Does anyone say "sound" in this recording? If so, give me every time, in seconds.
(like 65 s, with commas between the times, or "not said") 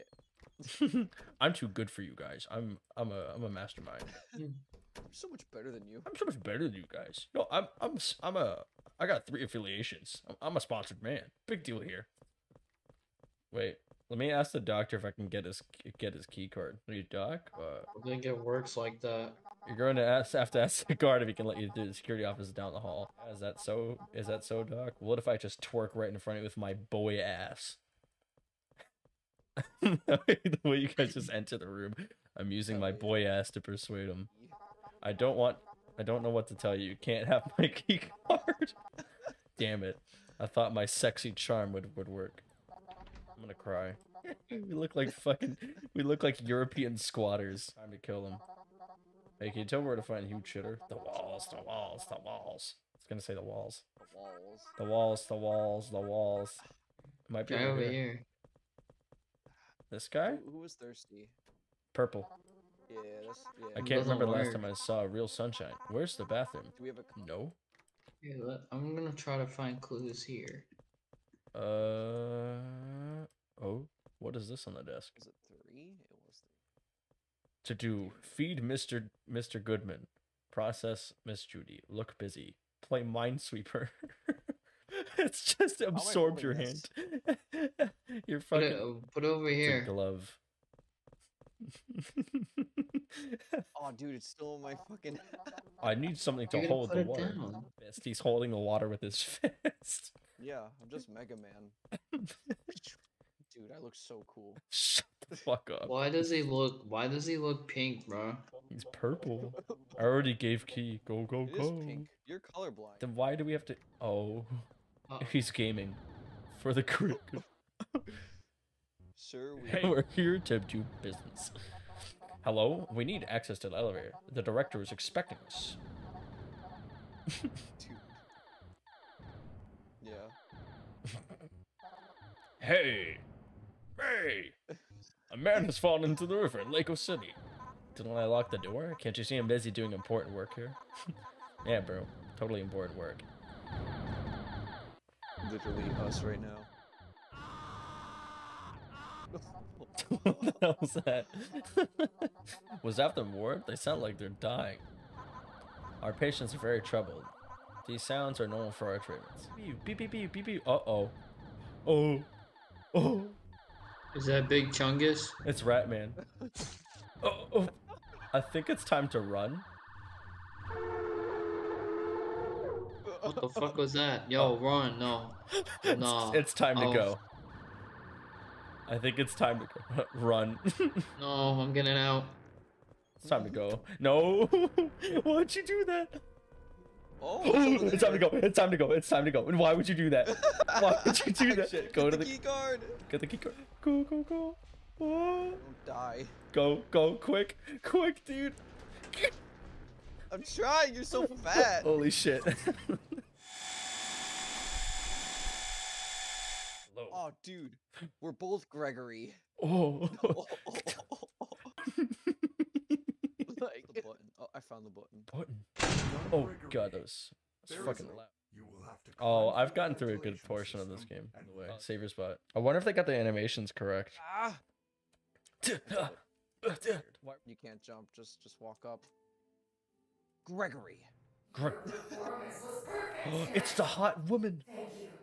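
153 s, 158 s.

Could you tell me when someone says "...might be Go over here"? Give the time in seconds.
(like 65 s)
57 s.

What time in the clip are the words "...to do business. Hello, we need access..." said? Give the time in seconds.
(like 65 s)
120 s.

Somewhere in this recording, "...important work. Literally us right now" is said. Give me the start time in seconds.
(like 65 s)
142 s.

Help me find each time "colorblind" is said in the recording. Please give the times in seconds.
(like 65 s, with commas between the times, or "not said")
112 s.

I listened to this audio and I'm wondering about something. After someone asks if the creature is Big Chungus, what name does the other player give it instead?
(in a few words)
Ratman.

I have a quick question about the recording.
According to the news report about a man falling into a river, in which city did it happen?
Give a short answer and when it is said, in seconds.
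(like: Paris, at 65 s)
Lake City, at 136 s.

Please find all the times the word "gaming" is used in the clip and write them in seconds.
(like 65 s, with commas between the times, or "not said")
115 s.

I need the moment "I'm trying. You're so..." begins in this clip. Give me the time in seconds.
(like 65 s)
200 s.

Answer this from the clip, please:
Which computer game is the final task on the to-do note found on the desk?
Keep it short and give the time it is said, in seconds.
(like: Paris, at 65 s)
Minesweeper, at 83 s.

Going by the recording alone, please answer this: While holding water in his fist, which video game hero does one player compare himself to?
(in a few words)
Mega Man.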